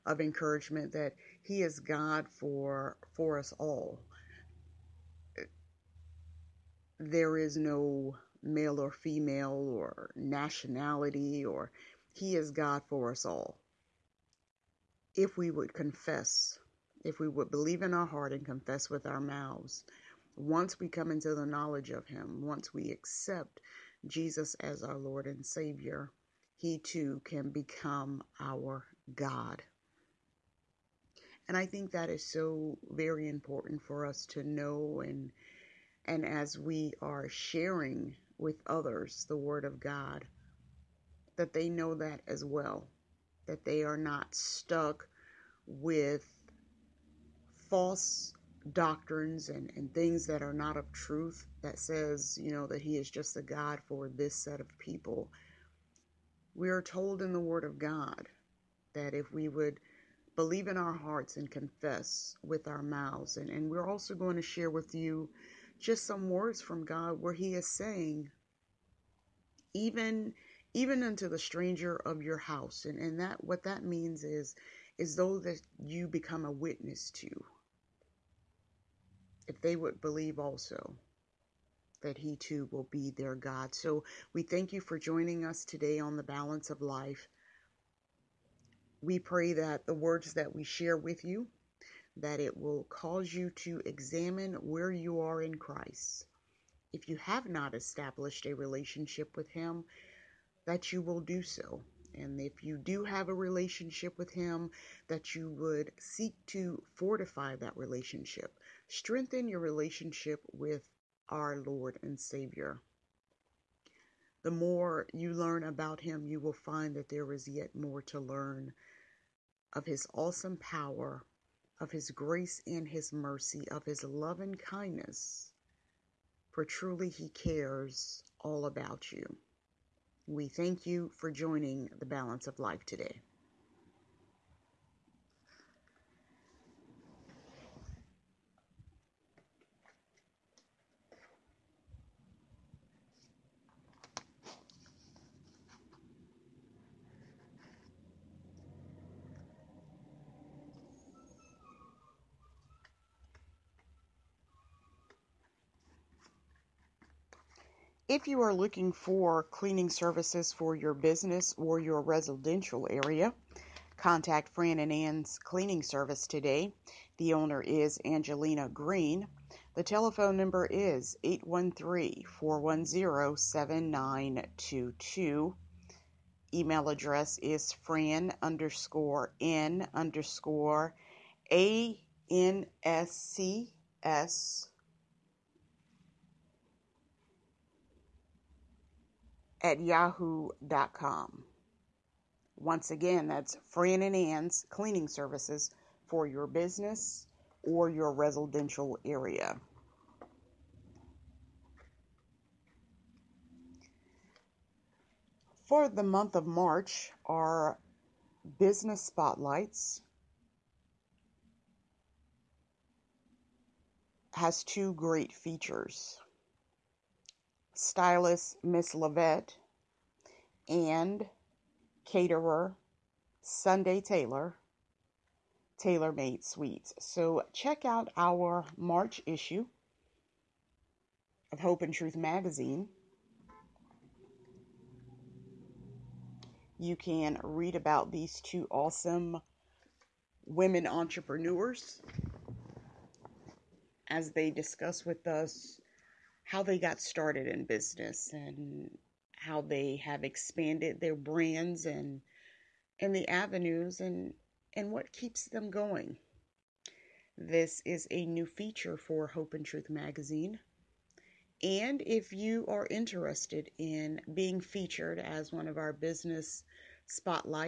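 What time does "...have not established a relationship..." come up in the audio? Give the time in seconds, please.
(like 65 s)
97 s.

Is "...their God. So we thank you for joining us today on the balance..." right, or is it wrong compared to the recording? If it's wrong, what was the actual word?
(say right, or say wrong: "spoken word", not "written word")
right.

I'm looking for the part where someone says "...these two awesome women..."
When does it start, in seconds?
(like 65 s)
238 s.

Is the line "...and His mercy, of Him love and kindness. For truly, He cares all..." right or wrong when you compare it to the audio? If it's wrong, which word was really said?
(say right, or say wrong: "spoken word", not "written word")
wrong: "His", not "Him".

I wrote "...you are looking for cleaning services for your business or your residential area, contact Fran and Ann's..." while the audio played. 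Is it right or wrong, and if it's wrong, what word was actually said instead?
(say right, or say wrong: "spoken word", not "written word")
right.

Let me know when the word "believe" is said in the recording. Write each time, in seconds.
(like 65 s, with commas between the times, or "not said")
17 s, 60 s, 79 s.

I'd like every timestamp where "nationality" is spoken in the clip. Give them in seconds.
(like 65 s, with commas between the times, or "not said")
10 s.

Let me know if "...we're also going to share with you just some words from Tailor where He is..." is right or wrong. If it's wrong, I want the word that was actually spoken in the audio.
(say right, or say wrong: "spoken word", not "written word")
wrong: "God", not "Tailor".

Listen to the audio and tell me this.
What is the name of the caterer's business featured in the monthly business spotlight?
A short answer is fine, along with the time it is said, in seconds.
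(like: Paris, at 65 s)
Tailor Made Sweets, at 225 s.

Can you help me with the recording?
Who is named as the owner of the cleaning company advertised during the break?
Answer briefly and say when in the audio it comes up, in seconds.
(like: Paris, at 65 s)
Angelina Green, at 168 s.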